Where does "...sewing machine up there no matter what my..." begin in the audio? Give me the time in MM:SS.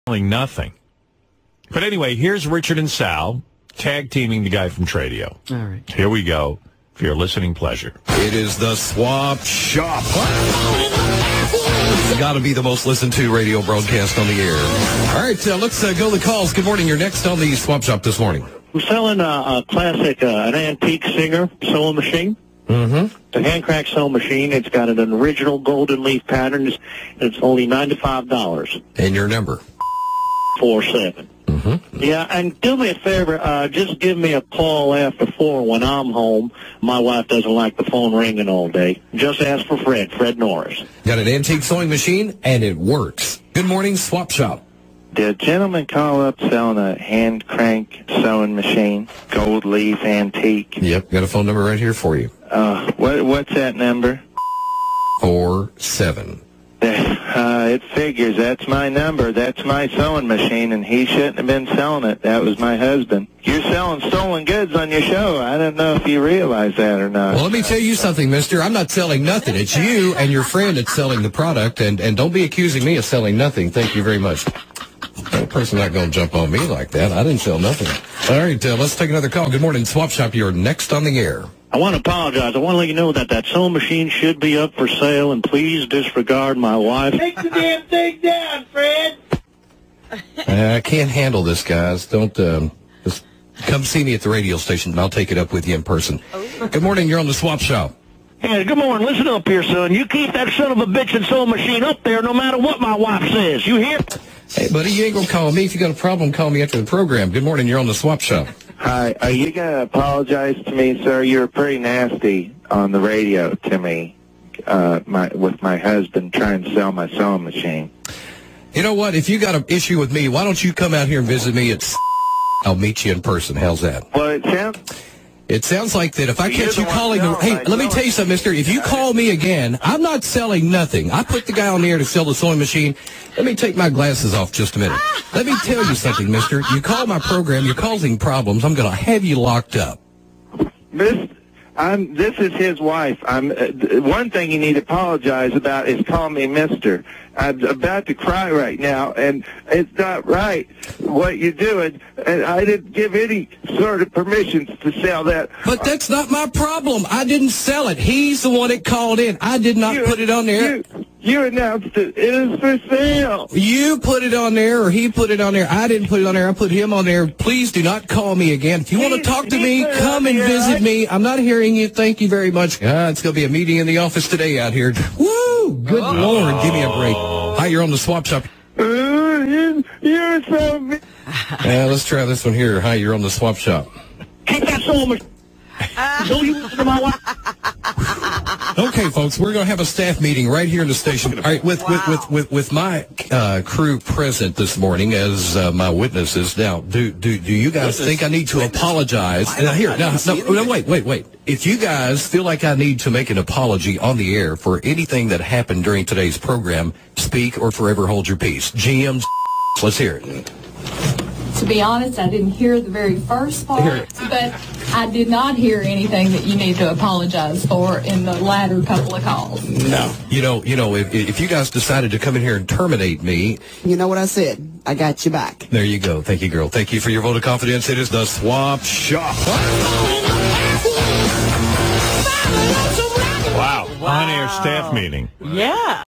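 01:41.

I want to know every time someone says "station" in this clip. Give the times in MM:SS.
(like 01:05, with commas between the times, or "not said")
01:34, 03:10.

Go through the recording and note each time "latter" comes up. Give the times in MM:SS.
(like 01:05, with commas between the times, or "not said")
03:38.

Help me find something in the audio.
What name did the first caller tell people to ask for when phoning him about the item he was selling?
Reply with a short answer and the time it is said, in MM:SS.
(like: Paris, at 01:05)
Fred Norris, at 00:40.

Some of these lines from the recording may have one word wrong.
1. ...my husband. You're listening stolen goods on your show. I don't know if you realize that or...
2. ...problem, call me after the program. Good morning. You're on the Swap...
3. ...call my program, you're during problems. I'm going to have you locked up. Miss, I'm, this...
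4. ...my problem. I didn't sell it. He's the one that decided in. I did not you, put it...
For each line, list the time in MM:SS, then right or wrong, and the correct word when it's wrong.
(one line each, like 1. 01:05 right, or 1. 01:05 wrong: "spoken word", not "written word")
1. 01:02 wrong: "selling", not "listening"
2. 01:45 right
3. 02:16 wrong: "causing", not "during"
4. 02:36 wrong: "called", not "decided".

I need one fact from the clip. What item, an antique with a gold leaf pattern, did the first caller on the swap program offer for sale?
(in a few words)
Singer sewing machine.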